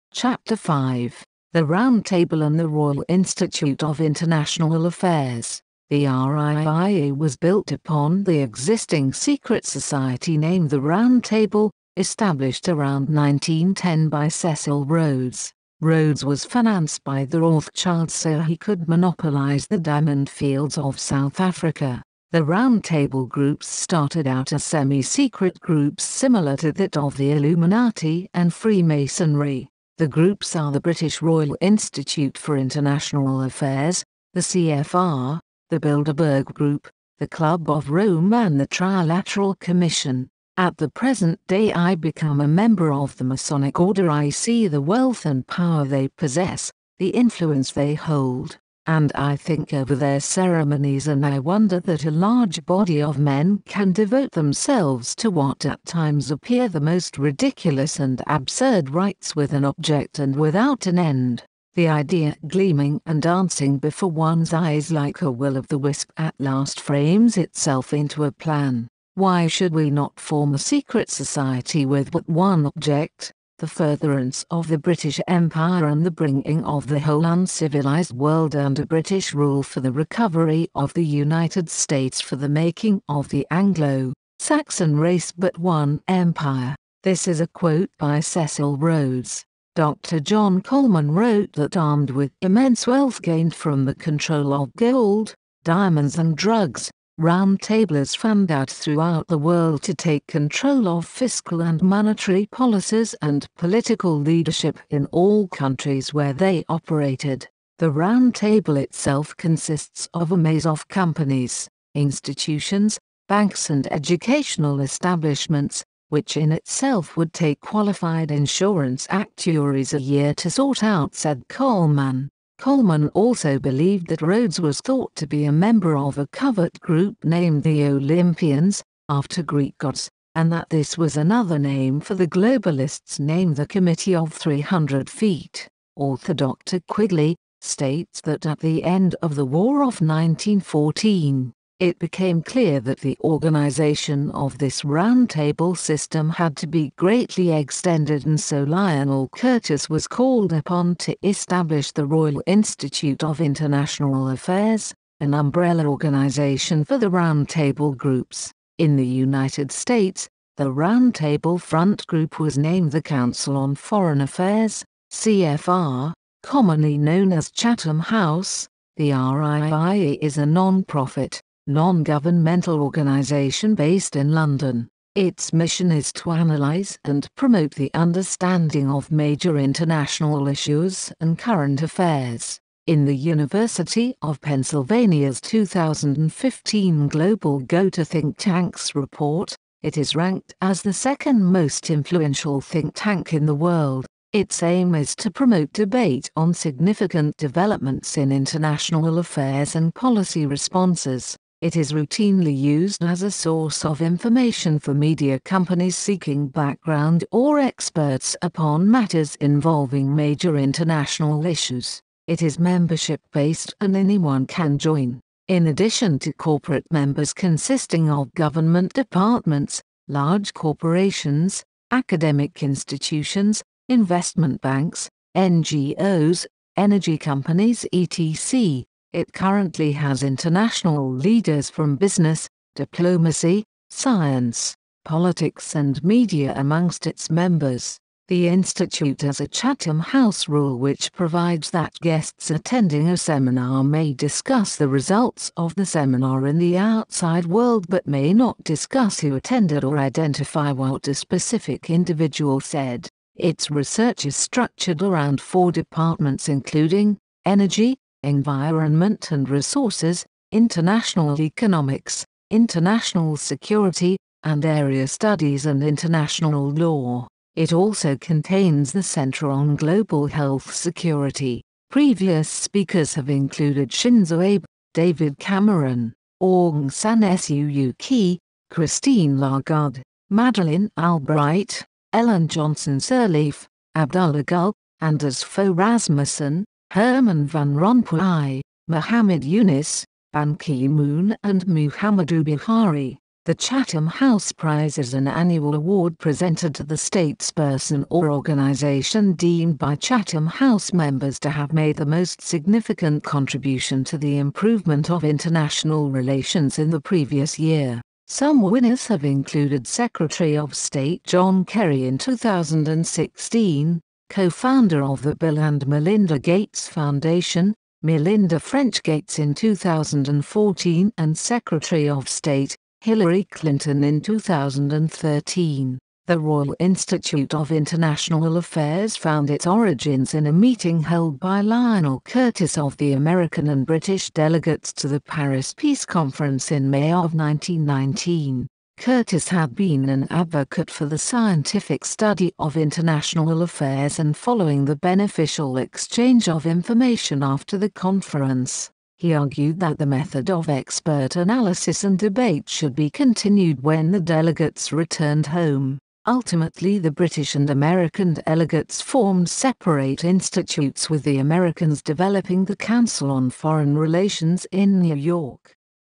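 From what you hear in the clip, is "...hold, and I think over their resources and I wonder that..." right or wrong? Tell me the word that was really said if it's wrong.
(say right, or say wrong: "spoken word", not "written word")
wrong: "ceremonies", not "resources".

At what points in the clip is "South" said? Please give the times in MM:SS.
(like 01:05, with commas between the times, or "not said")
00:20.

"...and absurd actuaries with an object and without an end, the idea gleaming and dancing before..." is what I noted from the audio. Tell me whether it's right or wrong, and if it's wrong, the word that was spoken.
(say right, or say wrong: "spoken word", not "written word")
wrong: "rites", not "actuaries".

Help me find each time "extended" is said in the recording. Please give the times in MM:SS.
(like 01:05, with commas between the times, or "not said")
02:27.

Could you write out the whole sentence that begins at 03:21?
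It is routinely used as a source of information for media companies seeking background or experts upon matters involving major international issues.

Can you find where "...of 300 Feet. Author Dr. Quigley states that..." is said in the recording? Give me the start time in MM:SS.
02:14.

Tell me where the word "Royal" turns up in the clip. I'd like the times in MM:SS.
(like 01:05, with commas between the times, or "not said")
00:02, 00:31, 02:32, 05:26.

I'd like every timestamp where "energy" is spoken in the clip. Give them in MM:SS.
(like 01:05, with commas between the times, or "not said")
03:46, 04:17.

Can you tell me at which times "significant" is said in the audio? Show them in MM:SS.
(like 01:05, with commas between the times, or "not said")
03:16, 05:02.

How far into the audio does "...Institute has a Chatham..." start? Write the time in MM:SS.
03:58.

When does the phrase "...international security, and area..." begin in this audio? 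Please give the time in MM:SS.
04:22.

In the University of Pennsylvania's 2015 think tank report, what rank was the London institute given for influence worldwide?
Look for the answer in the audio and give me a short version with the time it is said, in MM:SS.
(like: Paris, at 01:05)
Second, at 03:10.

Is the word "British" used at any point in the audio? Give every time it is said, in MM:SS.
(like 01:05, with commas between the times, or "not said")
00:30, 01:14, 01:18, 05:33, 05:57.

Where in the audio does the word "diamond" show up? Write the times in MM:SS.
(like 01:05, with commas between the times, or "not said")
00:19, 01:35.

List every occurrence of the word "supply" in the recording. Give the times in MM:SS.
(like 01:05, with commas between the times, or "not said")
not said.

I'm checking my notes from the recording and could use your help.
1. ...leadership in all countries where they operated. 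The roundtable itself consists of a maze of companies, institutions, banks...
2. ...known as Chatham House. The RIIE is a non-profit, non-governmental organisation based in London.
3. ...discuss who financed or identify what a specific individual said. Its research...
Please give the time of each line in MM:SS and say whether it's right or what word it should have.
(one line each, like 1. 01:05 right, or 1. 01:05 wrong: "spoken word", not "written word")
1. 01:44 right
2. 02:46 right
3. 04:08 wrong: "attended", not "financed".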